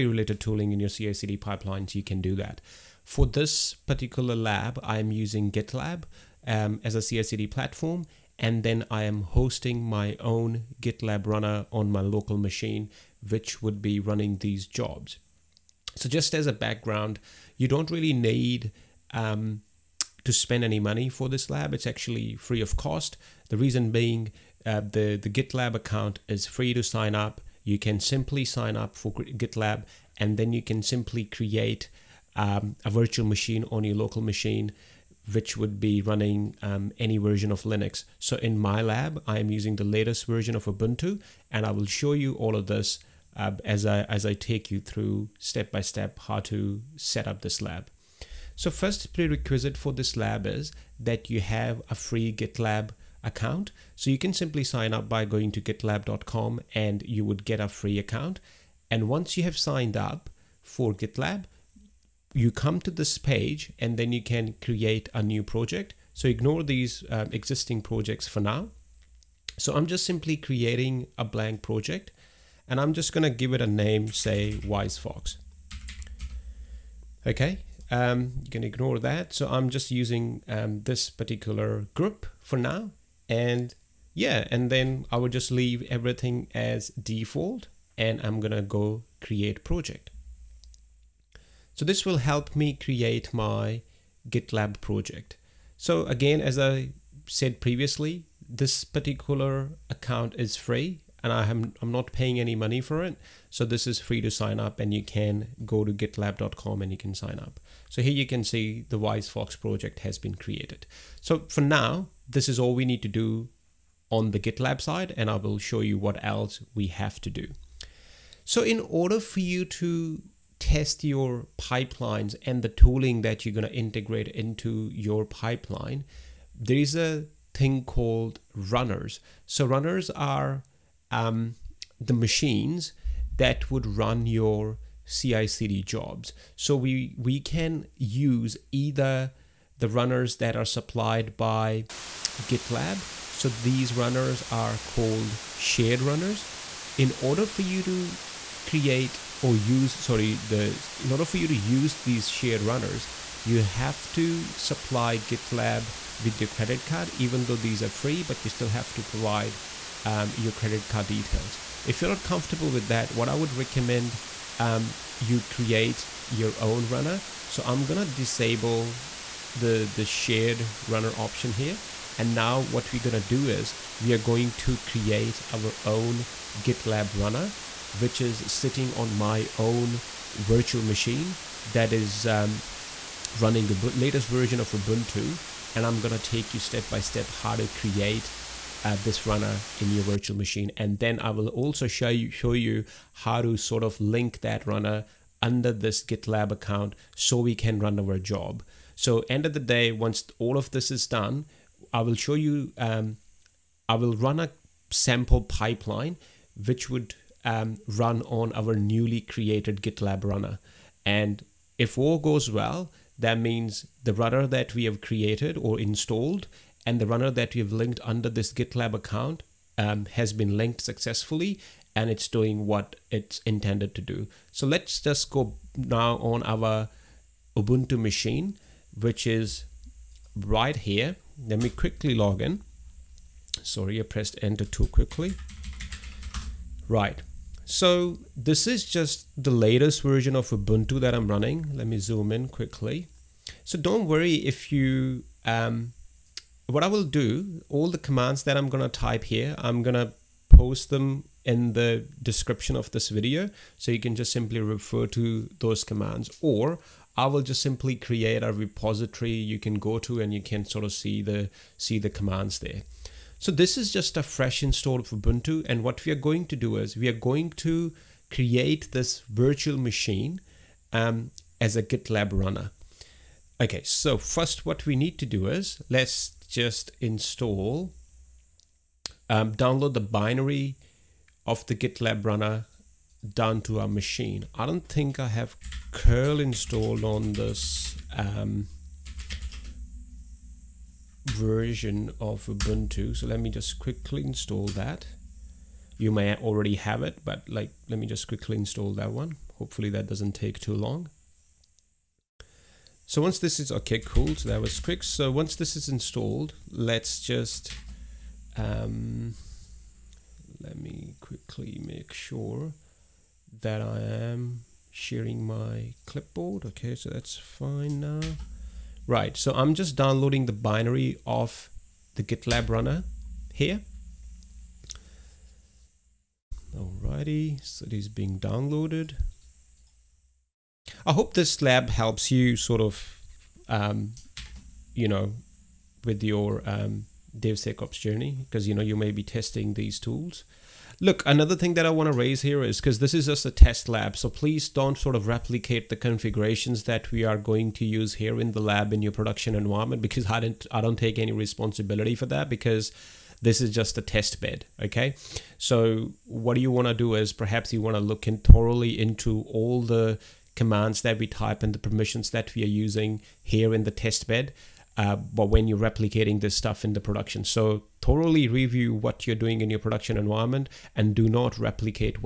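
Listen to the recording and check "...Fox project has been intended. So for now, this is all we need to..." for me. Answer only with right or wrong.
wrong.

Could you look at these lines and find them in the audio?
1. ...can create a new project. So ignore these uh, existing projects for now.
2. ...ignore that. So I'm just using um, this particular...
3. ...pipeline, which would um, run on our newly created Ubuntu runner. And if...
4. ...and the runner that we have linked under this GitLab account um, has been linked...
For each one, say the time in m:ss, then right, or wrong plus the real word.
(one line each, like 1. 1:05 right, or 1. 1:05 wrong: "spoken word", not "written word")
1. 1:04 right
2. 1:18 right
3. 3:25 wrong: "GitLab", not "Ubuntu"
4. 3:36 right.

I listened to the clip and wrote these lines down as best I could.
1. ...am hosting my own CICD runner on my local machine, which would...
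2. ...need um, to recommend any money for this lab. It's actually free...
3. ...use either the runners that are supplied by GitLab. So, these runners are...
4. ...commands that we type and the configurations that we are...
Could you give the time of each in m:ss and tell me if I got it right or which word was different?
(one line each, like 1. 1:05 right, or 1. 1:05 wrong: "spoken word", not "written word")
1. 0:09 wrong: "GitLab", not "CICD"
2. 0:18 wrong: "spend", not "recommend"
3. 2:17 right
4. 6:00 wrong: "permissions", not "configurations".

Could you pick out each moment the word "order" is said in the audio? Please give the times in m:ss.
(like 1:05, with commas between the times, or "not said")
1:58, 2:27, 2:31.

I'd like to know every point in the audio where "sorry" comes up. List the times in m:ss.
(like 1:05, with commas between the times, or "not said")
2:29, 3:53.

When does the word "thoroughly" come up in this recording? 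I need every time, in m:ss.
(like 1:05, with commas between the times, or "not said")
5:58, 6:08.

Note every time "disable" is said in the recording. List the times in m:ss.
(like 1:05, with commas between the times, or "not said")
2:48.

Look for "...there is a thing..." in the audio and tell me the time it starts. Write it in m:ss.
2:06.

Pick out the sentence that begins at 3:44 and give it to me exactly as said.
So let's just go now on our Ubuntu machine, which is right here.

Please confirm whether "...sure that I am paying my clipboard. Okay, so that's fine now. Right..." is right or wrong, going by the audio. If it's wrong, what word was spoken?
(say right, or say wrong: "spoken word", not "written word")
wrong: "sharing", not "paying".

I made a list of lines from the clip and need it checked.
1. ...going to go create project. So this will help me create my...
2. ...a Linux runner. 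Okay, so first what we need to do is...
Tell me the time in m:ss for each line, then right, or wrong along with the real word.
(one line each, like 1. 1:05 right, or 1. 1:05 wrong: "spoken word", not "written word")
1. 1:28 right
2. 4:31 wrong: "GitLab", not "Linux".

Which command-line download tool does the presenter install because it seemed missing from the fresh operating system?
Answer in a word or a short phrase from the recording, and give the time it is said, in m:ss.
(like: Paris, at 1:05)
curl, at 4:45.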